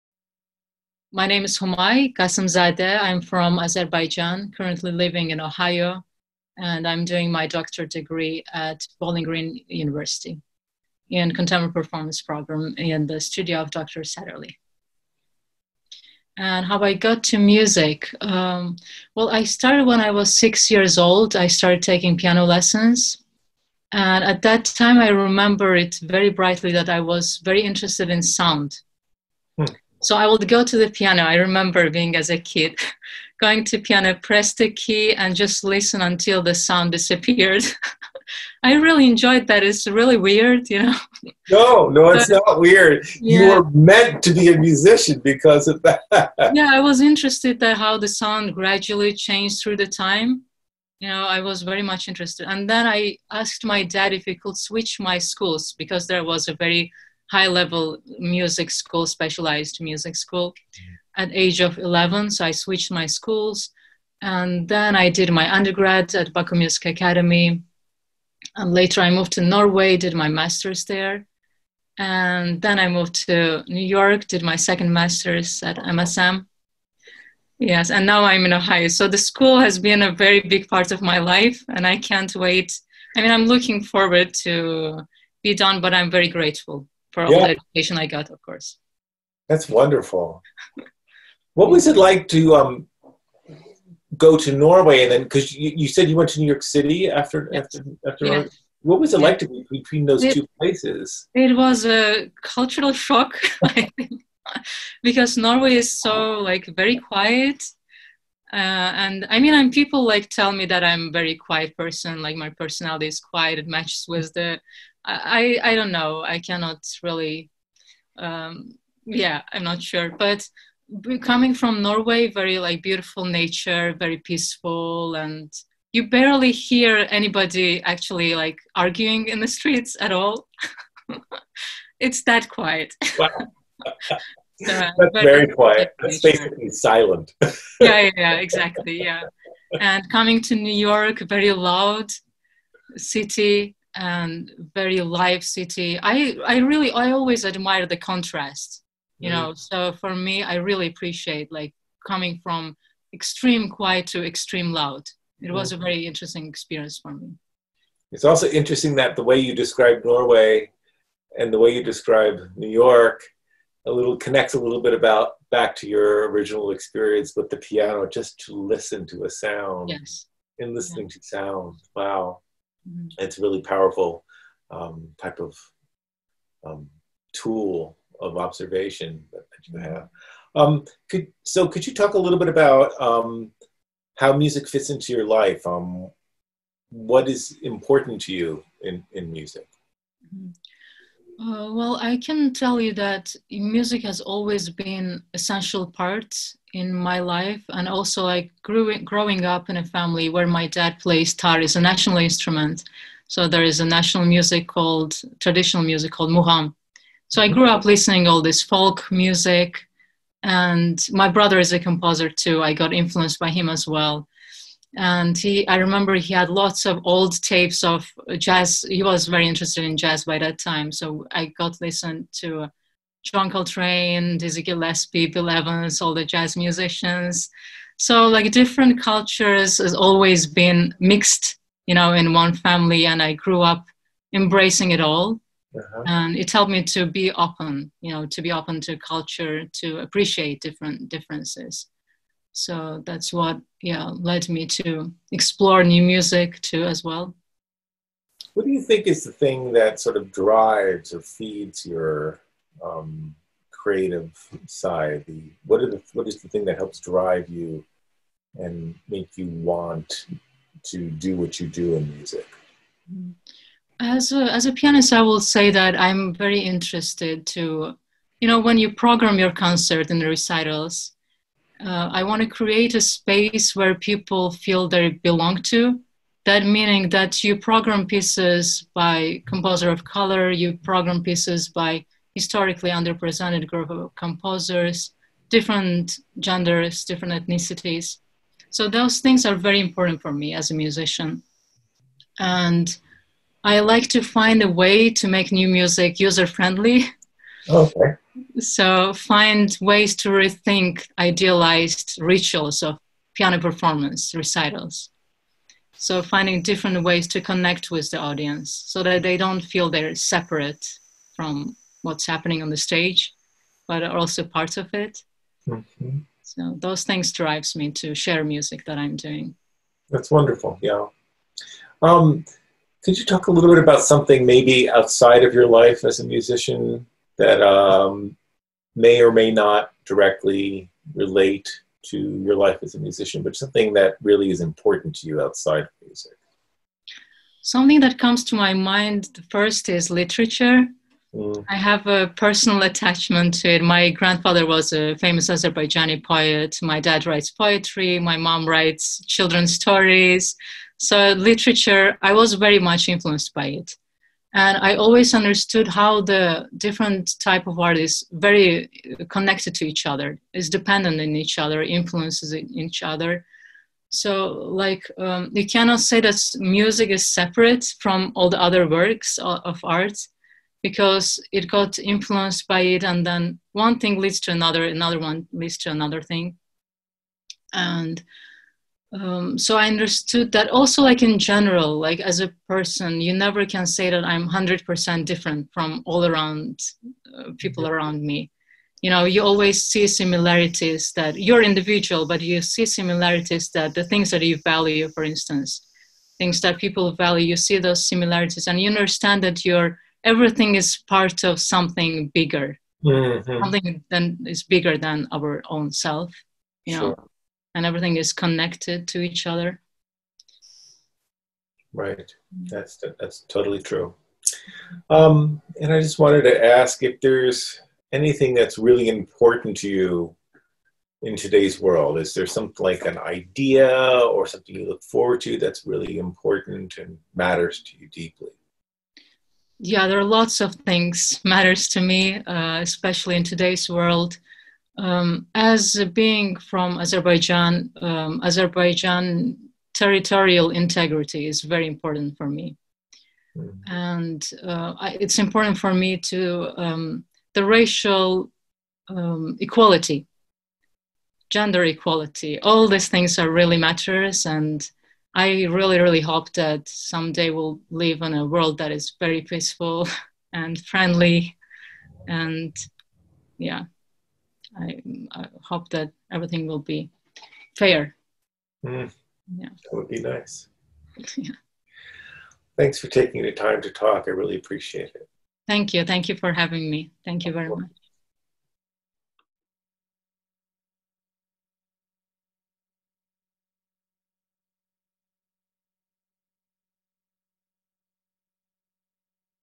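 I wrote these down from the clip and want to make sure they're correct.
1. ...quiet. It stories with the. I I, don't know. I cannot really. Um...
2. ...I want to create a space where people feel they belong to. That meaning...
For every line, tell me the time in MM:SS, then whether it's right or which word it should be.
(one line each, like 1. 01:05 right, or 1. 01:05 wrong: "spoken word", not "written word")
1. 01:53 wrong: "matches", not "stories"
2. 04:32 right.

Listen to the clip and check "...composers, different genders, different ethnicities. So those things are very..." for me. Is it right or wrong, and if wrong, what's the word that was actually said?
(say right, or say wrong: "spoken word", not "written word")
right.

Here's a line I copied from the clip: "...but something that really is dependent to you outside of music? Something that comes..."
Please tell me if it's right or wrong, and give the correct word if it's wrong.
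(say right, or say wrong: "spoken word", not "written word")
wrong: "important", not "dependent".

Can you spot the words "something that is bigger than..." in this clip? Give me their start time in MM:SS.
06:43.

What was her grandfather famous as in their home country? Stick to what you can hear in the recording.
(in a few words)
Poet.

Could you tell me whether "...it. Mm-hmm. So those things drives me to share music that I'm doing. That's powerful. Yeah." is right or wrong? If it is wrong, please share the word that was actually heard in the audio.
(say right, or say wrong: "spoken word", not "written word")
wrong: "wonderful", not "powerful".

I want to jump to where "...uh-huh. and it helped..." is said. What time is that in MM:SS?
03:55.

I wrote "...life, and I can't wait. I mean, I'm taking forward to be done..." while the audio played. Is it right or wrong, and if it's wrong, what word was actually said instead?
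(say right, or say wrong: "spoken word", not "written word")
wrong: "looking", not "taking".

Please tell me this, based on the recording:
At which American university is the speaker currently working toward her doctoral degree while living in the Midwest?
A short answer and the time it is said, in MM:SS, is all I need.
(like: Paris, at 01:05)
Bowling Green University, at 00:08.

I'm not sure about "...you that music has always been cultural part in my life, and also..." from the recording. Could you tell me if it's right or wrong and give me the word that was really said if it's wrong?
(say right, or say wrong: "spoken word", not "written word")
wrong: "essential", not "cultural".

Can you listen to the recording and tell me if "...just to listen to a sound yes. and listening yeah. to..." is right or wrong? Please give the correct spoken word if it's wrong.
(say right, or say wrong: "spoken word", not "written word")
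right.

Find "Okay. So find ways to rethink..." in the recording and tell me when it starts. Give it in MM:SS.
04:57.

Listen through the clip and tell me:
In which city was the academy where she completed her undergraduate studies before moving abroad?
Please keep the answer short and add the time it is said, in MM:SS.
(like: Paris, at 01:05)
Baku, at 01:06.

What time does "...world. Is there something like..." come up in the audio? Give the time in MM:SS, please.
07:01.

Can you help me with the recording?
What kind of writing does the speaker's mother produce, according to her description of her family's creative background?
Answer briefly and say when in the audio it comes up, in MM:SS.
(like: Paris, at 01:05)
Children's stories, at 05:49.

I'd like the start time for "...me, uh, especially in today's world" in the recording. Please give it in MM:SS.
07:12.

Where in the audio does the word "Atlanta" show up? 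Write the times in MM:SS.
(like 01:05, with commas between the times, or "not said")
not said.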